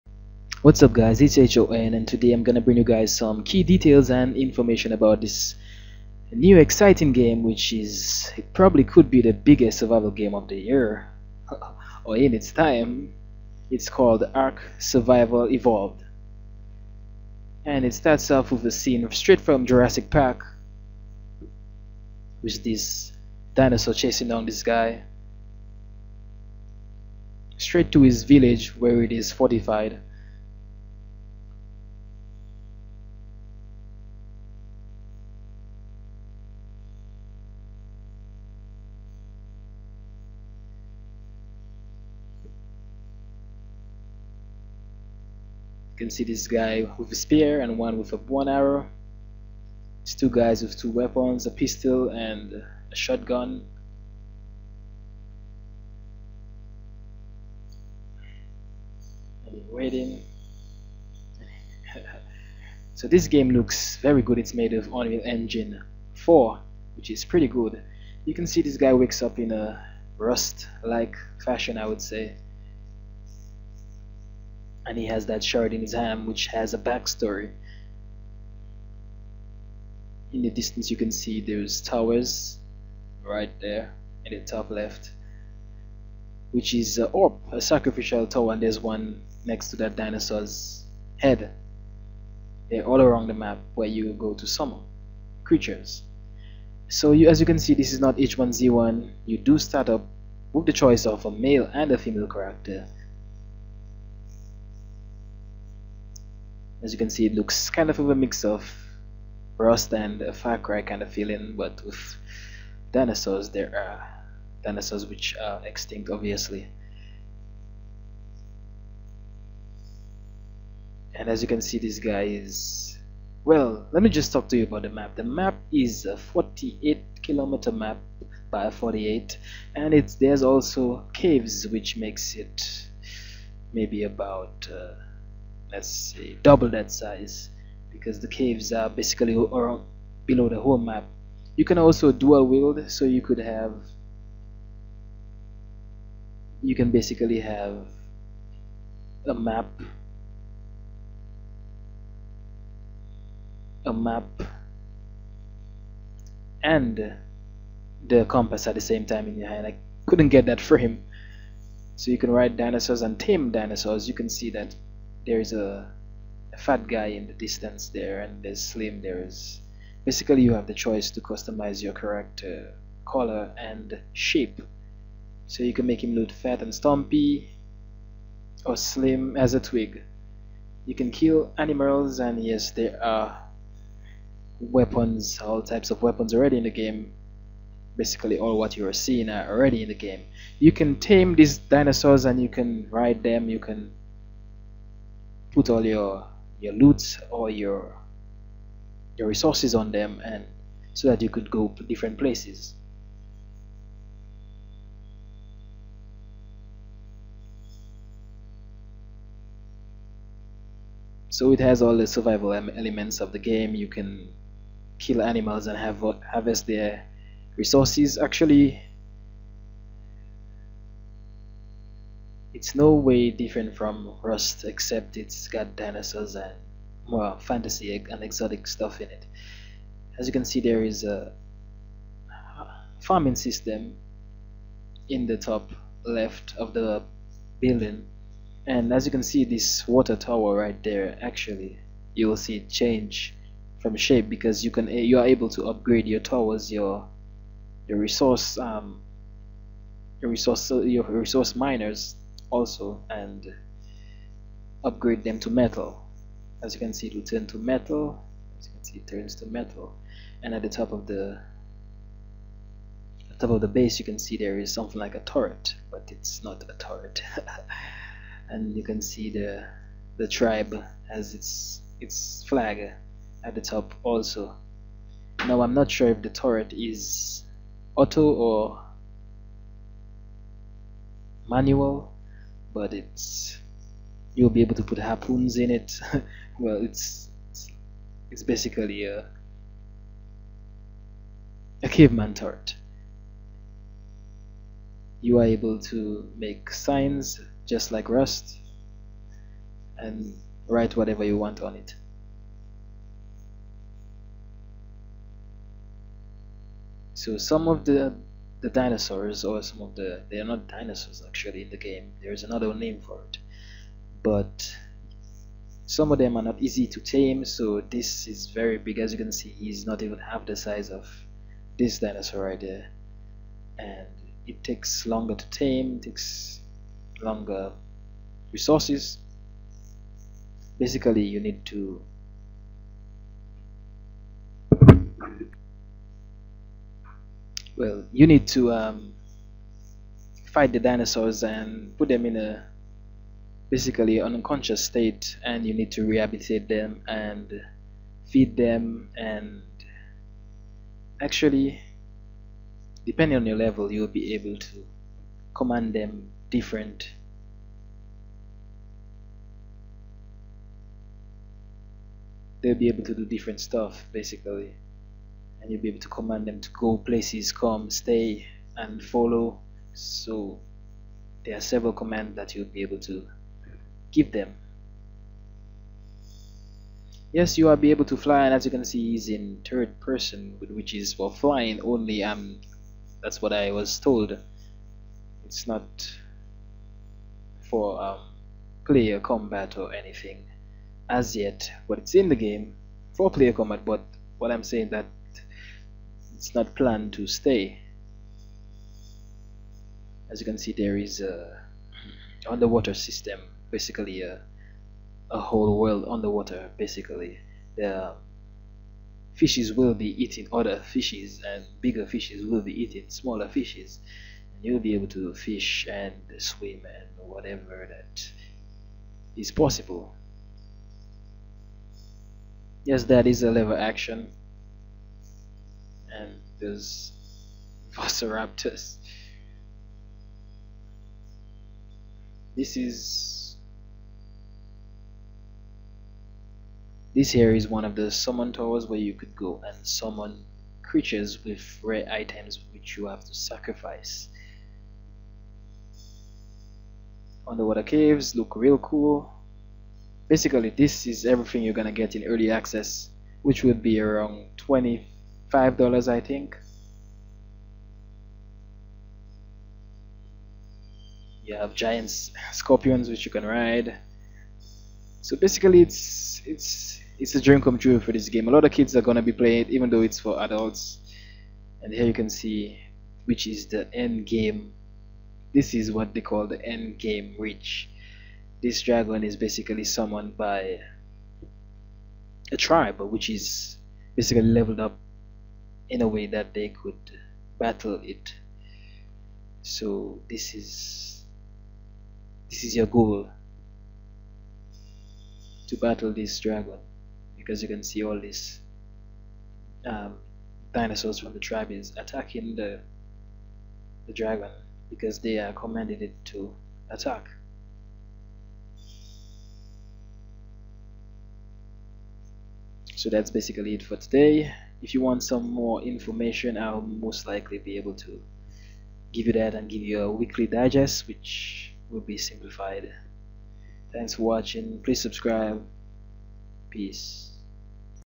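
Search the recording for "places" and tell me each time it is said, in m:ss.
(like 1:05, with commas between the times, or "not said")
3:22, 6:06.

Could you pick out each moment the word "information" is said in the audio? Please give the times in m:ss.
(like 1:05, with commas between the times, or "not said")
0:04, 8:35.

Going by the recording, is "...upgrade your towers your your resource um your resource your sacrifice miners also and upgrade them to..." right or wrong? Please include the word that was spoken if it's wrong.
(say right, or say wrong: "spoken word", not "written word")
wrong: "resource", not "sacrifice".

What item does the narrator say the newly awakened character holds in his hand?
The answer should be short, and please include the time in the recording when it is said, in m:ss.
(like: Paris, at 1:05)
shard, at 1:15.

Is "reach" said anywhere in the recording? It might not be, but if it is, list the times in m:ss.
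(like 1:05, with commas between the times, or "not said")
7:57.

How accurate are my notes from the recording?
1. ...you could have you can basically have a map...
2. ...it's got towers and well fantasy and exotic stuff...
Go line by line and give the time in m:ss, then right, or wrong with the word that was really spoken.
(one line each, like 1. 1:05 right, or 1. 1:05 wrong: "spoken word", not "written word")
1. 2:23 right
2. 3:45 wrong: "dinosaurs", not "towers".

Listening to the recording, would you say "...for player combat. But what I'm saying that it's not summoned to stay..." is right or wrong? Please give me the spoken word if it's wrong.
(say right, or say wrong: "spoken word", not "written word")
wrong: "planned", not "summoned".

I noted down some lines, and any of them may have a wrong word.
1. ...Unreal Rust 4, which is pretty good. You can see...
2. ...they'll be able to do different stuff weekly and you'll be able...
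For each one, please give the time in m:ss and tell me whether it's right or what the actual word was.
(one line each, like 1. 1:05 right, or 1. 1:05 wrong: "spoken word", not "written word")
1. 1:04 wrong: "Engine", not "Rust"
2. 6:02 wrong: "basically", not "weekly".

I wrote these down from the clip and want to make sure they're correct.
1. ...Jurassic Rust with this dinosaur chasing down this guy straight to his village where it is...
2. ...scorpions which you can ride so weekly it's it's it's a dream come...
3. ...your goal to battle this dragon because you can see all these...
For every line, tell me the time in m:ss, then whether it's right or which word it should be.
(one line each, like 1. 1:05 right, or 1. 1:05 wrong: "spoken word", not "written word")
1. 0:19 wrong: "Park", not "Rust"
2. 7:42 wrong: "basically", not "weekly"
3. 8:12 right.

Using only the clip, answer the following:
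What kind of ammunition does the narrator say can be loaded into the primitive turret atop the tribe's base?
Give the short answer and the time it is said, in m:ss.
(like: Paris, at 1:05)
harpoons, at 4:44.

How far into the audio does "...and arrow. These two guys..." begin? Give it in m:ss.
0:48.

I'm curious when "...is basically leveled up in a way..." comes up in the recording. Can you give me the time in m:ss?
8:03.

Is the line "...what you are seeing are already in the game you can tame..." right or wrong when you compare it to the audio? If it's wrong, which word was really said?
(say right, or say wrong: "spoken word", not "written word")
right.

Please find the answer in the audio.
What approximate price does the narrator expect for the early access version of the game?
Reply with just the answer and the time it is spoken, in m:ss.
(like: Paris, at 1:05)
$25, at 7:34.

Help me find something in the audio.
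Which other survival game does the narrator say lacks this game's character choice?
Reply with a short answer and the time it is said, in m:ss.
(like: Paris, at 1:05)
H1Z1, at 1:38.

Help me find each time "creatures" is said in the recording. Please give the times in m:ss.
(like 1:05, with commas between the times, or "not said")
1:35, 7:20.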